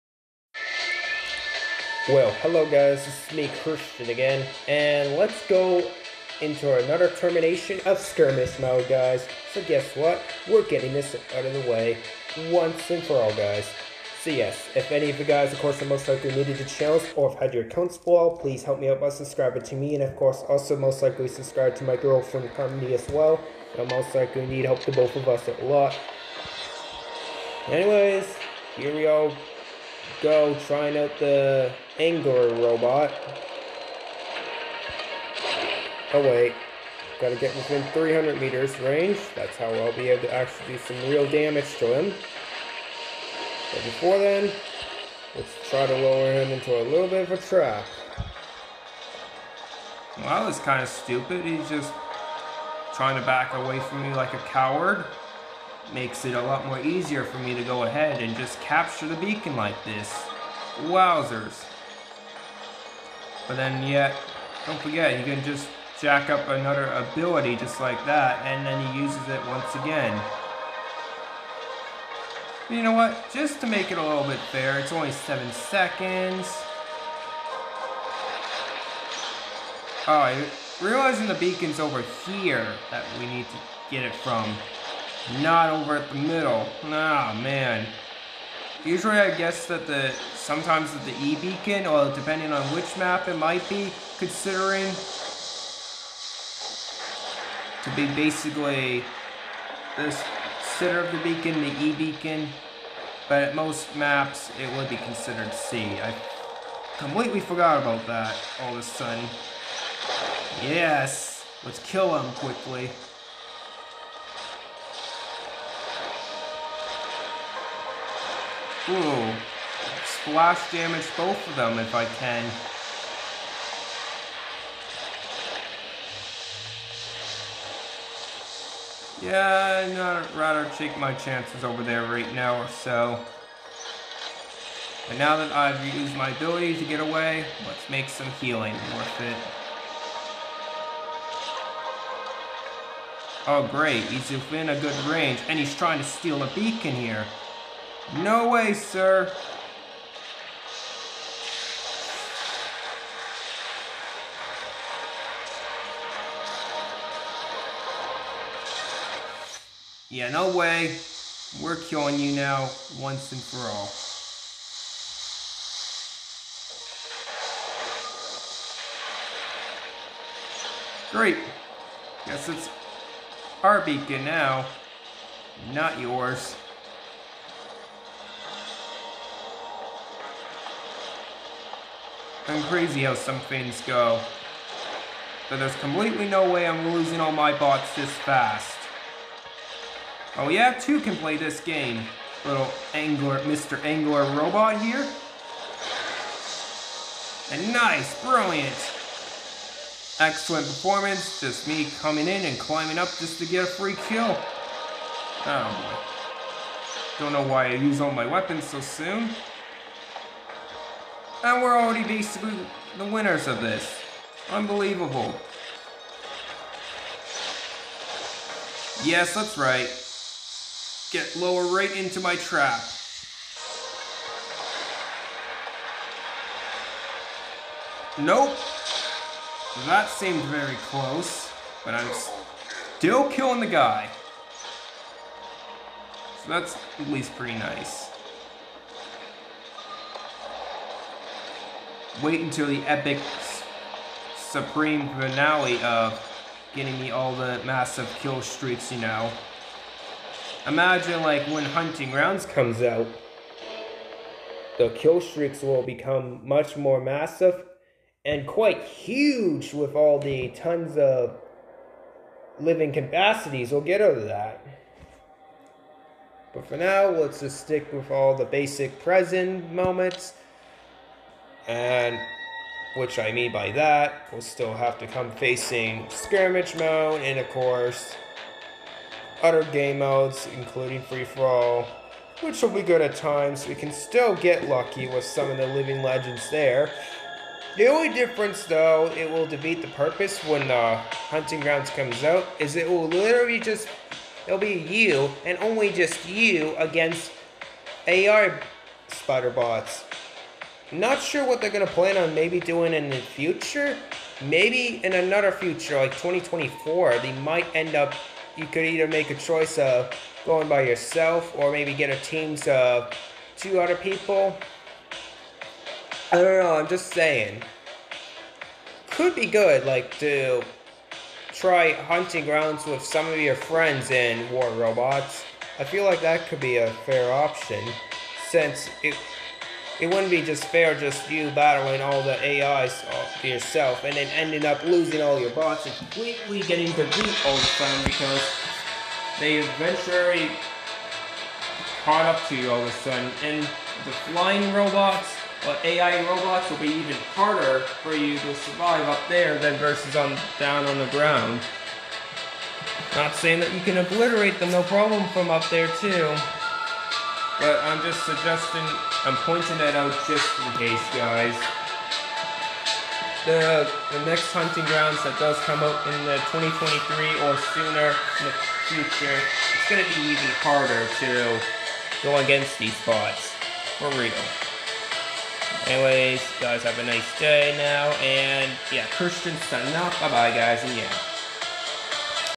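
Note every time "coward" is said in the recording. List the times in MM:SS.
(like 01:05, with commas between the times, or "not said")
00:54.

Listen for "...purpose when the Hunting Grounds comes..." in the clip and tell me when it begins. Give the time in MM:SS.
04:49.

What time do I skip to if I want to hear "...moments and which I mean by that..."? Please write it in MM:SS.
04:29.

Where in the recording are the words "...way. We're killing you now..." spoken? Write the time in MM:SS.
02:40.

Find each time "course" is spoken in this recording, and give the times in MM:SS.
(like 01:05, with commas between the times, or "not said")
00:15, 00:20, 04:37.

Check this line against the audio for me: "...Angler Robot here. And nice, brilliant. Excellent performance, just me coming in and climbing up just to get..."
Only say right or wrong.
right.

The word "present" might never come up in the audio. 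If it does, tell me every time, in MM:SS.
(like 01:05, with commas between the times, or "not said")
04:29.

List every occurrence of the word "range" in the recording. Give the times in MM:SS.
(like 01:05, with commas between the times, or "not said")
00:38, 02:25.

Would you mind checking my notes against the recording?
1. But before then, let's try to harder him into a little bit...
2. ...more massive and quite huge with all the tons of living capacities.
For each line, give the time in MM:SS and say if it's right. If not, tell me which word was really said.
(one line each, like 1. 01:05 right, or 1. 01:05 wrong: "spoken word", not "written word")
1. 00:43 wrong: "lower", not "harder"
2. 04:16 right.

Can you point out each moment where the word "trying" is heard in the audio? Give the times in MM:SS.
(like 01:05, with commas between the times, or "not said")
00:30, 00:52, 02:25.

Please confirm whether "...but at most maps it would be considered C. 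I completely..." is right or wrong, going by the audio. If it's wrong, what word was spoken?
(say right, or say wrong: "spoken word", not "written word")
right.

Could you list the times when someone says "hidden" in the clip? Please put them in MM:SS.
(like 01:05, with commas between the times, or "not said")
not said.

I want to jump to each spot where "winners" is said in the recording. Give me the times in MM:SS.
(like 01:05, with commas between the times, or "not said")
03:33.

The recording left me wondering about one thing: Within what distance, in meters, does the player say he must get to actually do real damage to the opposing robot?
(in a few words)
300 meters.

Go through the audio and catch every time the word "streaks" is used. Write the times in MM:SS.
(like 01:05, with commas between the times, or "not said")
04:08, 04:15.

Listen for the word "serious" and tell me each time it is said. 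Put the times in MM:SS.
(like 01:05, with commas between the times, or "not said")
not said.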